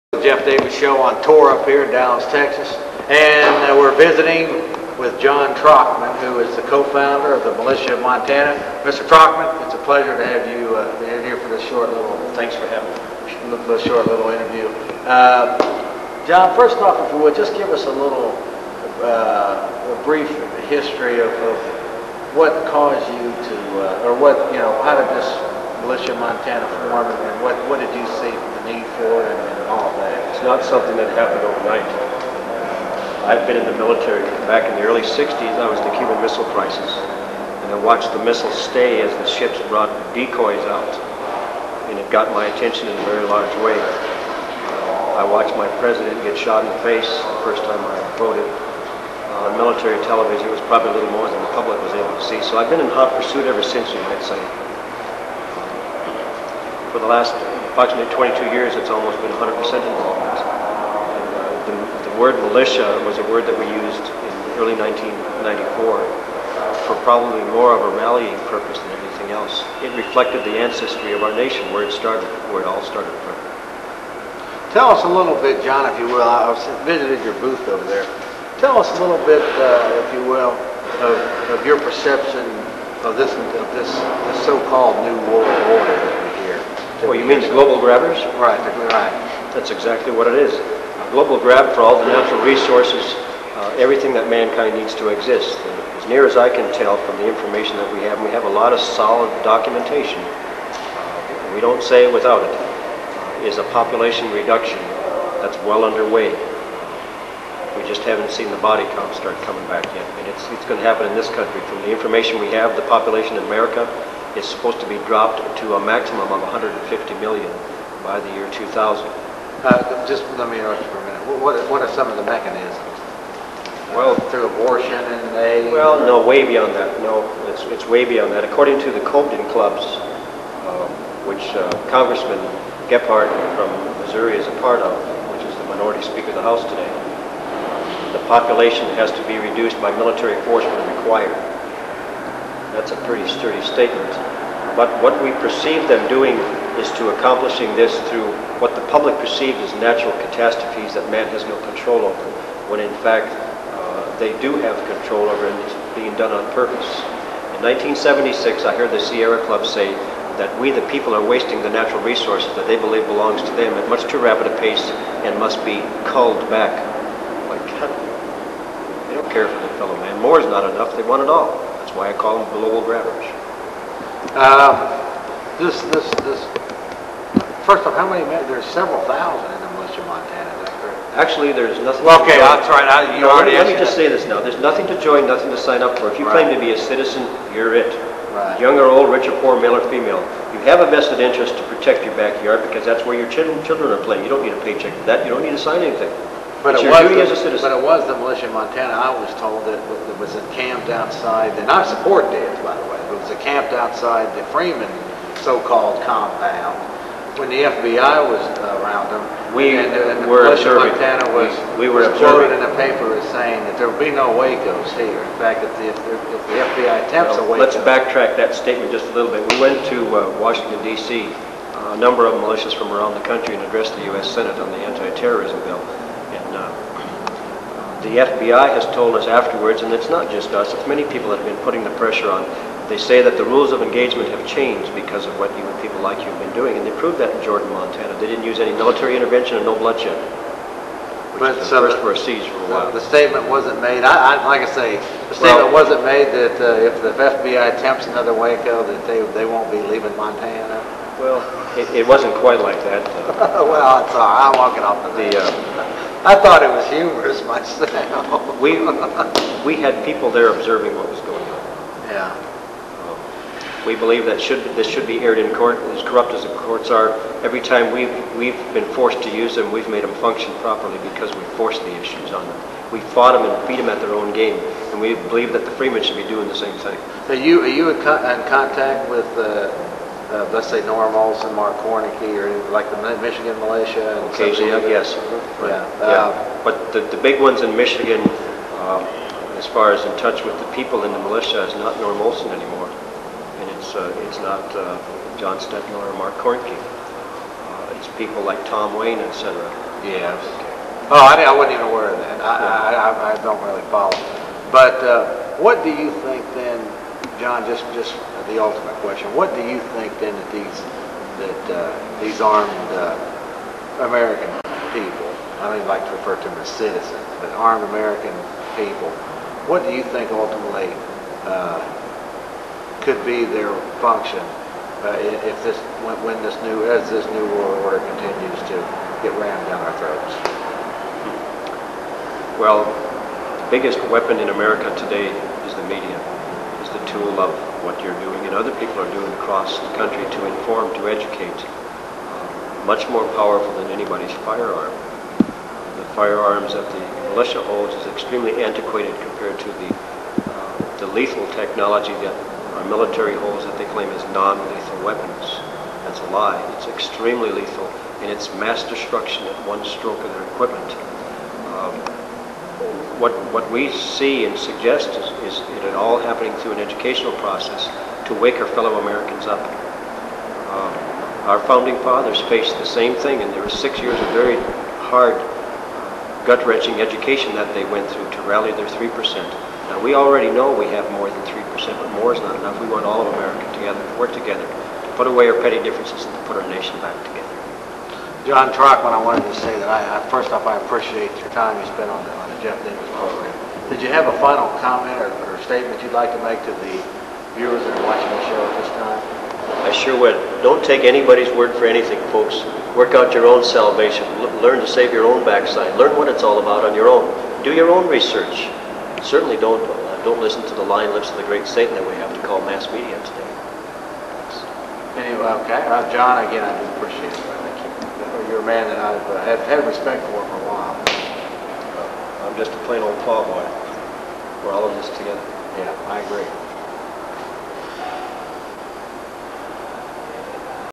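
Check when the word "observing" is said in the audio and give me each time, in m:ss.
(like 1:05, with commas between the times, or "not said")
3:30, 4:20.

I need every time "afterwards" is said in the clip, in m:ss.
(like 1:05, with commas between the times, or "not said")
3:49.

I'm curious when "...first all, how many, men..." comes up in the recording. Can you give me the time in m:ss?
2:57.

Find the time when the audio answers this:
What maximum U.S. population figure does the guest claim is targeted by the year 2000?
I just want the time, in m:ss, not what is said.
1:56.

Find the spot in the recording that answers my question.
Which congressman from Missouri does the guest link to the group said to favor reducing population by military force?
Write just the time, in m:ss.
2:12.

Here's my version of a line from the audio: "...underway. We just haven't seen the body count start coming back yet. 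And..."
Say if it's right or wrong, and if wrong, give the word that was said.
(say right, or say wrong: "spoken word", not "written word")
right.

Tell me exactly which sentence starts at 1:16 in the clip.
I visited your booth over there.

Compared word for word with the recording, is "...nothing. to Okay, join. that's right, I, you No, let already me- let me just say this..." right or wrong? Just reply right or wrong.
right.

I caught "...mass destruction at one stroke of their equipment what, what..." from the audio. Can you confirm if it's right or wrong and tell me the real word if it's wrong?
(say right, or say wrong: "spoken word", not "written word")
right.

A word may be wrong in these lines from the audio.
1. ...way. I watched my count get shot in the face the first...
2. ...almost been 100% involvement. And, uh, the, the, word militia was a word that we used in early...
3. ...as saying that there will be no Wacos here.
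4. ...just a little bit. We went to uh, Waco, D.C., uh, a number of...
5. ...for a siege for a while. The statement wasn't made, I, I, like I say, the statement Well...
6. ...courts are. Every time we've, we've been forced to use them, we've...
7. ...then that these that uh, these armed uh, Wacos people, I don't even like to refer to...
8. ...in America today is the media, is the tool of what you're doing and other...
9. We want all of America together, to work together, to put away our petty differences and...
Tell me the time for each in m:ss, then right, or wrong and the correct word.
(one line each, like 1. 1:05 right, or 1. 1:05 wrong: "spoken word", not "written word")
1. 0:43 wrong: "president", not "count"
2. 0:58 right
3. 3:33 right
4. 3:38 wrong: "Washington", not "Waco"
5. 4:02 right
6. 4:26 right
7. 5:10 wrong: "American", not "Wacos"
8. 5:34 right
9. 6:22 right.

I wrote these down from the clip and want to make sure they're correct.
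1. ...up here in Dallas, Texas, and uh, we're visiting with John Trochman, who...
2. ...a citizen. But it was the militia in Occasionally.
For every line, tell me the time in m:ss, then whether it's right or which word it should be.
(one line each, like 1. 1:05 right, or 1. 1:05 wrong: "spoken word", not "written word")
1. 0:01 right
2. 3:17 wrong: "Montana", not "Occasionally".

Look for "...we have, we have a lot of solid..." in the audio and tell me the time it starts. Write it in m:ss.
1:37.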